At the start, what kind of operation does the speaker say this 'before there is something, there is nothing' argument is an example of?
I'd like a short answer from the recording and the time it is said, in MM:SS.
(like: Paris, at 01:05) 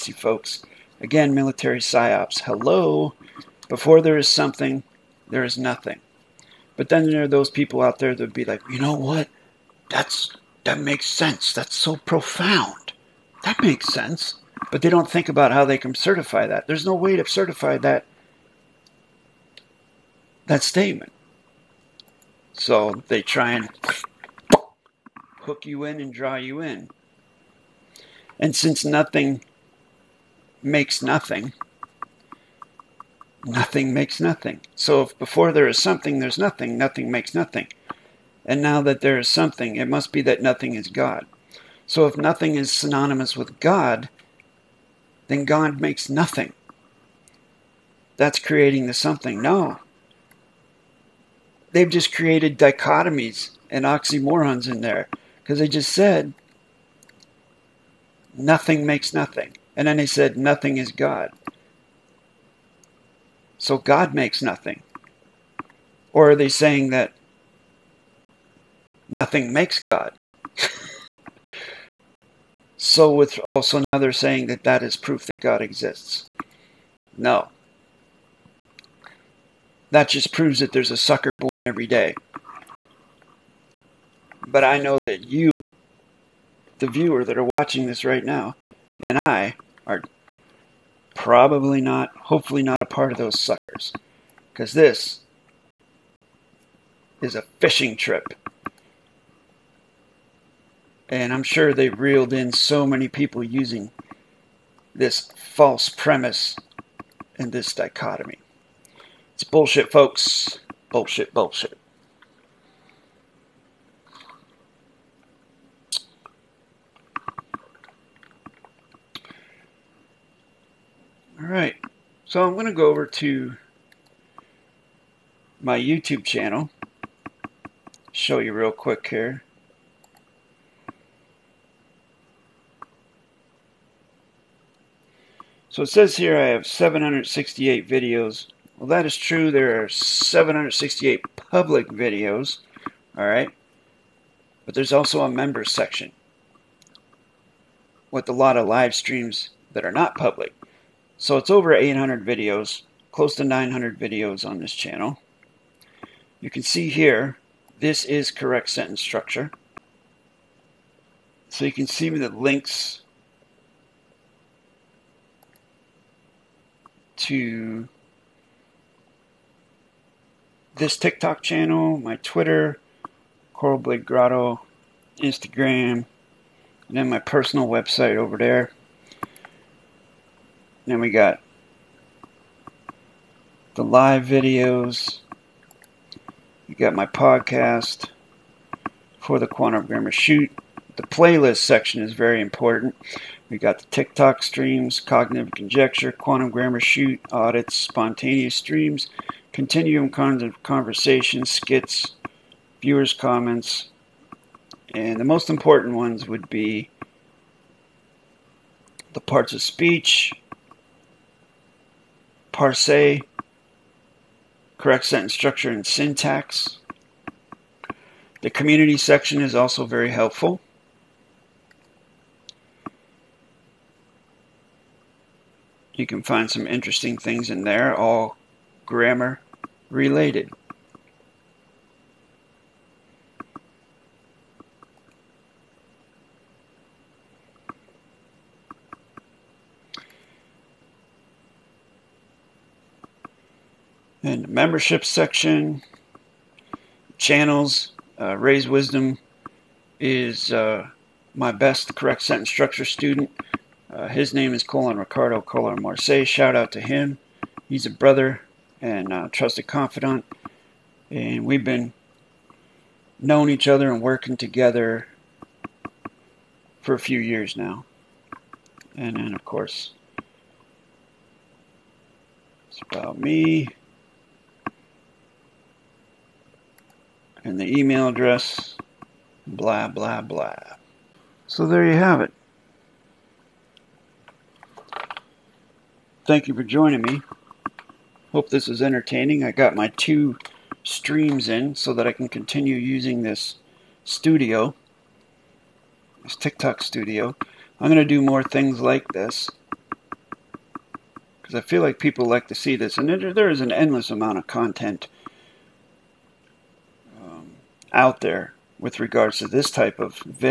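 military psyops, at 00:01.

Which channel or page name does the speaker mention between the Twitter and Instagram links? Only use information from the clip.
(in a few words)
Coral Blade Grotto.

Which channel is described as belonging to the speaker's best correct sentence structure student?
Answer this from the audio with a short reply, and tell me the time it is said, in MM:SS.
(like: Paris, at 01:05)
Raise Wisdom, at 04:08.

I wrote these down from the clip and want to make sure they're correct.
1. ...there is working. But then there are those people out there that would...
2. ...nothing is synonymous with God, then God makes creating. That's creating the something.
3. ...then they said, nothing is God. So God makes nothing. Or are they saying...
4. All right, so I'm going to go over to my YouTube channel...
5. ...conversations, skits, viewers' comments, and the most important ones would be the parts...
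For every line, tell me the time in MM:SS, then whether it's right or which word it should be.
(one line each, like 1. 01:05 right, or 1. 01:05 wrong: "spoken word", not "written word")
1. 00:05 wrong: "nothing", not "working"
2. 00:42 wrong: "nothing", not "creating"
3. 00:59 right
4. 02:01 right
5. 03:20 right.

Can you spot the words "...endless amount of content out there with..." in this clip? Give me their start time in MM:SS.
05:03.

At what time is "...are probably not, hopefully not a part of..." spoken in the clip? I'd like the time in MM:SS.
01:29.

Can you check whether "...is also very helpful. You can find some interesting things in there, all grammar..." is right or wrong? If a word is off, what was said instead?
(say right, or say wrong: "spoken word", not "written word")
right.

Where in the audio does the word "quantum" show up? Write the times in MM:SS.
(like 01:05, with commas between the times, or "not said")
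03:09, 03:16.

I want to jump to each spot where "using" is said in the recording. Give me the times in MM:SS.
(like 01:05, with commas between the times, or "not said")
01:43, 04:52.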